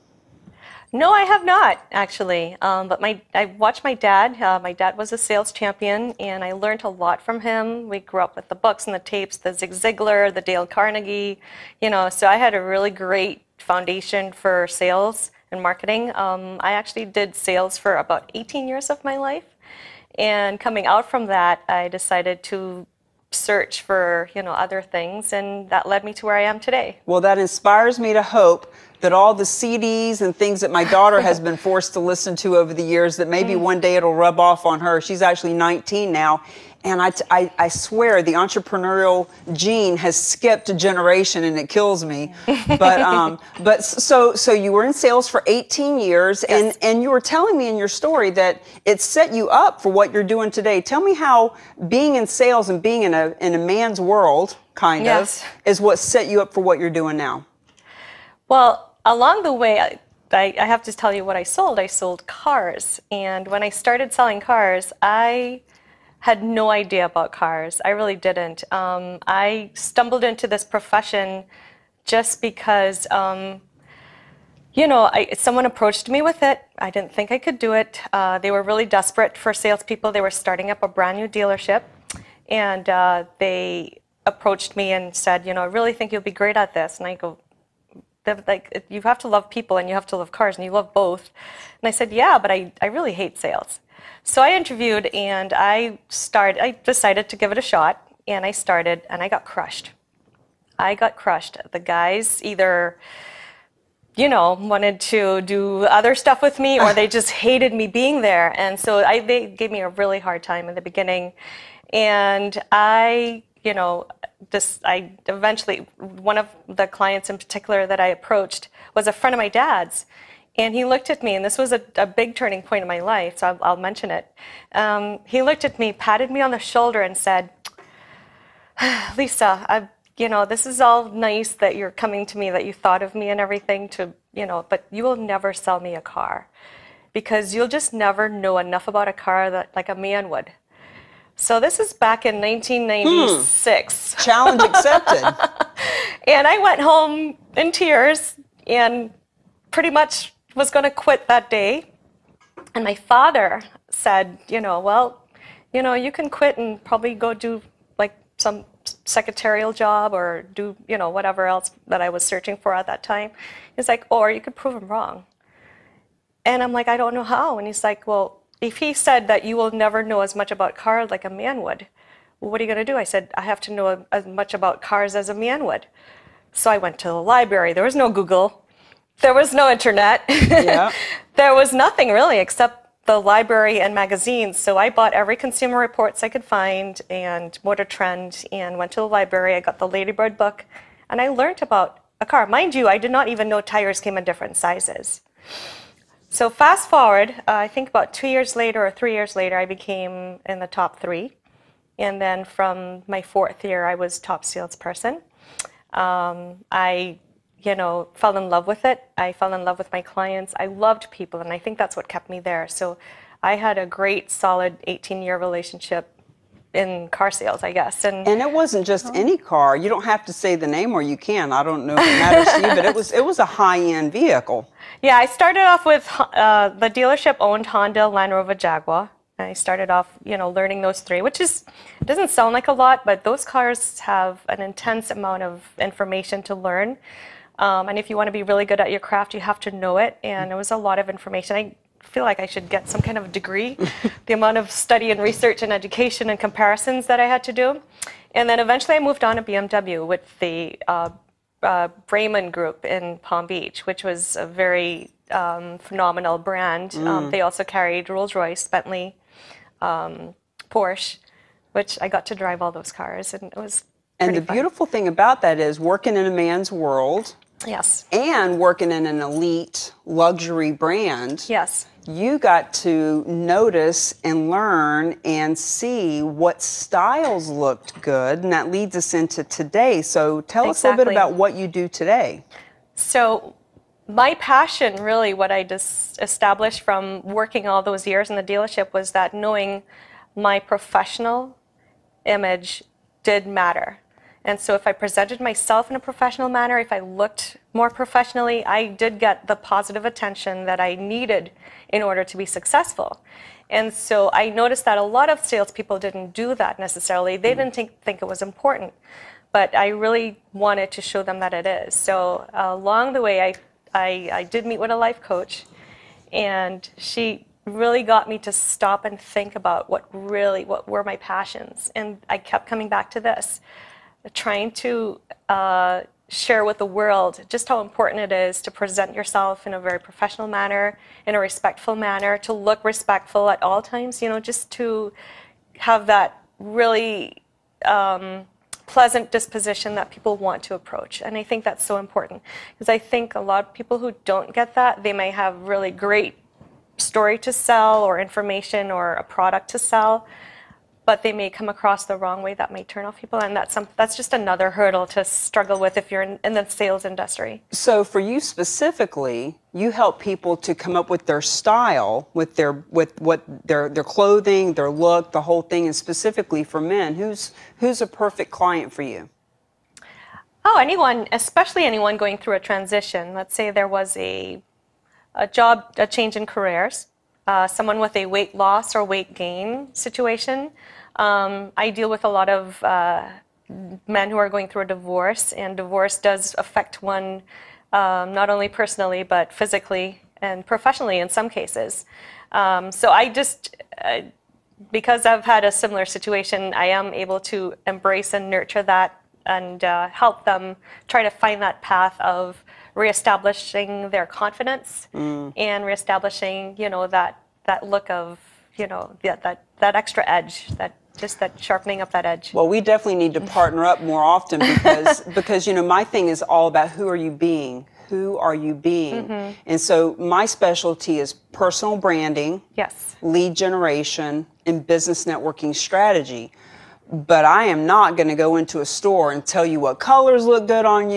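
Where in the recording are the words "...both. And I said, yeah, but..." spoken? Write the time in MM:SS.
01:30.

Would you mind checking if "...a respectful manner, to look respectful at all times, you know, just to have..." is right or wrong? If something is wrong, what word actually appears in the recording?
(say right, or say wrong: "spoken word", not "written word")
right.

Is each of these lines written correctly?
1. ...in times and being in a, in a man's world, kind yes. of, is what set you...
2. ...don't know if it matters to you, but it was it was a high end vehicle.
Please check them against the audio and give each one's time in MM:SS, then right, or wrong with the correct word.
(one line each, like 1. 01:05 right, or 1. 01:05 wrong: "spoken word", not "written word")
1. 00:52 wrong: "sales", not "times"
2. 03:41 right.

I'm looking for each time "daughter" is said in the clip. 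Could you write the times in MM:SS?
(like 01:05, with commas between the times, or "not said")
00:30.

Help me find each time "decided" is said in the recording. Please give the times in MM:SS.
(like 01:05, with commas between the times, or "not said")
00:21, 01:36.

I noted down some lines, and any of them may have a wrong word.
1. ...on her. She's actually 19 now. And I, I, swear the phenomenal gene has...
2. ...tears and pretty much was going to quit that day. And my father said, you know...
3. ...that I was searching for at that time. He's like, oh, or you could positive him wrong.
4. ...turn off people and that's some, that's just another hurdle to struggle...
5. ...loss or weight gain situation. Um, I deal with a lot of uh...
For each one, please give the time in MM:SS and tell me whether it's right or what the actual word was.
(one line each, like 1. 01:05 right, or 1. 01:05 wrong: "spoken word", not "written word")
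1. 00:34 wrong: "entrepreneurial", not "phenomenal"
2. 02:27 right
3. 02:41 wrong: "prove", not "positive"
4. 05:52 right
5. 06:18 right.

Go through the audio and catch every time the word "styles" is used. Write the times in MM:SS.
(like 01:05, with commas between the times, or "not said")
04:36, 06:01.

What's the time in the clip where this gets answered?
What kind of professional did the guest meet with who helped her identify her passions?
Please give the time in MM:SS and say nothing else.
05:14.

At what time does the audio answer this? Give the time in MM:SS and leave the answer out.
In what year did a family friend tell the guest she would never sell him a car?
02:22.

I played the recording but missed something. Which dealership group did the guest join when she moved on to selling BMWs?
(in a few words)
Braman Group.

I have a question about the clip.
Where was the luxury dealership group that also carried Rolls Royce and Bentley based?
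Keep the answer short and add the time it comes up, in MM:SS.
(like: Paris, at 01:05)
Palm Beach, at 04:13.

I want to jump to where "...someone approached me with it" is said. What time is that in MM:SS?
01:15.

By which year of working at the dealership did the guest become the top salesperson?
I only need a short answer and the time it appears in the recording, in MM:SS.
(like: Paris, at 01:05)
fourth year, at 03:23.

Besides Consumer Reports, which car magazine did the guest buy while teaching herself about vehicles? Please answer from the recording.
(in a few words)
Motor Trend.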